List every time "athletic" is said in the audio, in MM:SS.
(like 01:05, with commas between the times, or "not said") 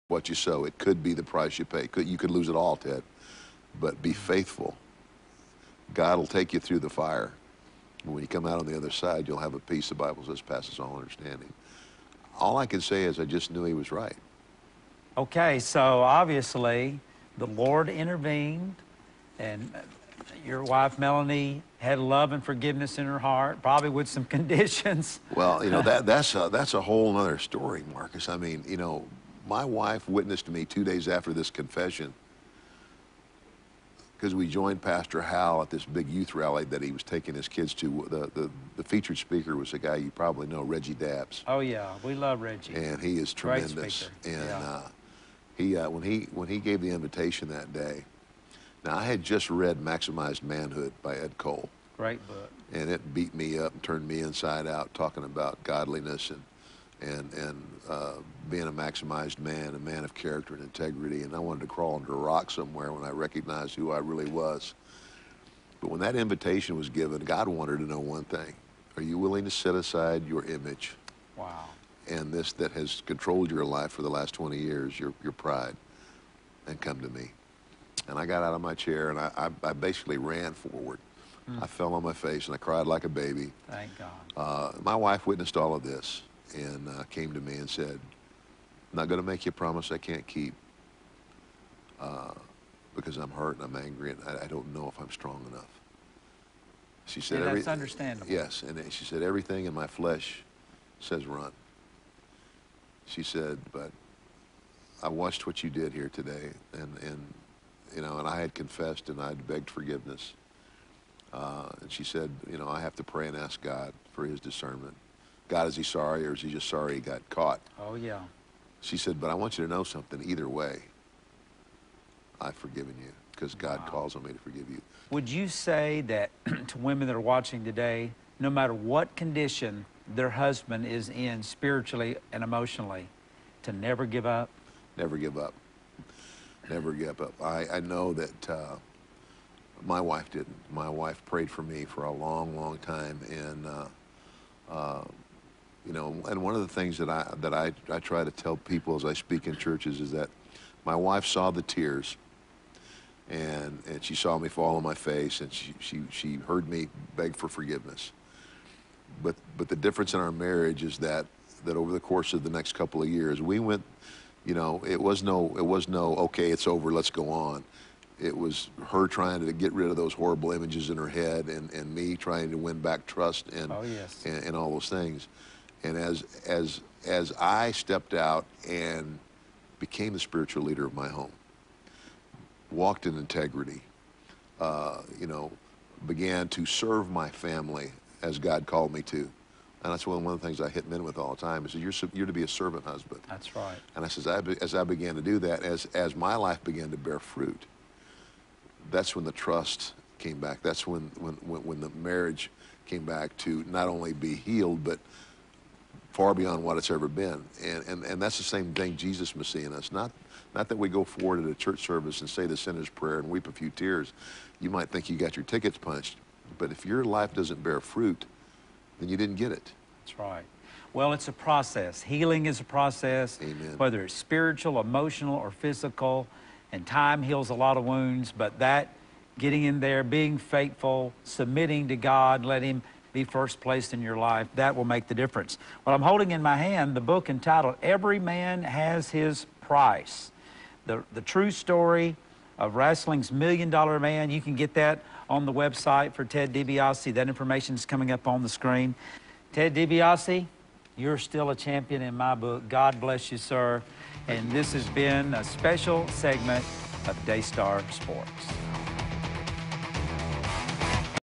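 not said.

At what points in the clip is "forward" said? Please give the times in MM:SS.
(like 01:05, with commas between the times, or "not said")
01:20, 03:31.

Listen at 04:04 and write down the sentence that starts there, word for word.
You can get that on the website for Ted DiBiase.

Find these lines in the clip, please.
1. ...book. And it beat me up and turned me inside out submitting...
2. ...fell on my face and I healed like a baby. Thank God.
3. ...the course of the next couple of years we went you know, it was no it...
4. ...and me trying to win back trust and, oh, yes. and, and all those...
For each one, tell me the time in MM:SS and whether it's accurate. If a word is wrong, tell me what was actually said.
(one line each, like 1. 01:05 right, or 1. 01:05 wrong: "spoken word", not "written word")
1. 00:52 wrong: "talking", not "submitting"
2. 01:21 wrong: "cried", not "healed"
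3. 02:41 right
4. 02:51 right.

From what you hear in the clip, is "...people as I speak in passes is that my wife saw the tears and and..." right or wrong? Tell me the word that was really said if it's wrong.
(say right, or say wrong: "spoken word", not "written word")
wrong: "churches", not "passes".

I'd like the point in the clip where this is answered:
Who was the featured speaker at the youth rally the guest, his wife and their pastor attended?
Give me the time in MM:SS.
00:40.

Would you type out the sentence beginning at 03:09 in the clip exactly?
And that's one, one of the things I hit men with all the time is you're, you're to be a servant husband.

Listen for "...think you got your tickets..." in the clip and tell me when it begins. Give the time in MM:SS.
03:34.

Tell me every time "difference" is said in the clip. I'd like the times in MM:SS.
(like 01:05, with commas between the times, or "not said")
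02:39, 03:55.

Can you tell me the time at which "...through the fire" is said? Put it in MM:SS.
00:06.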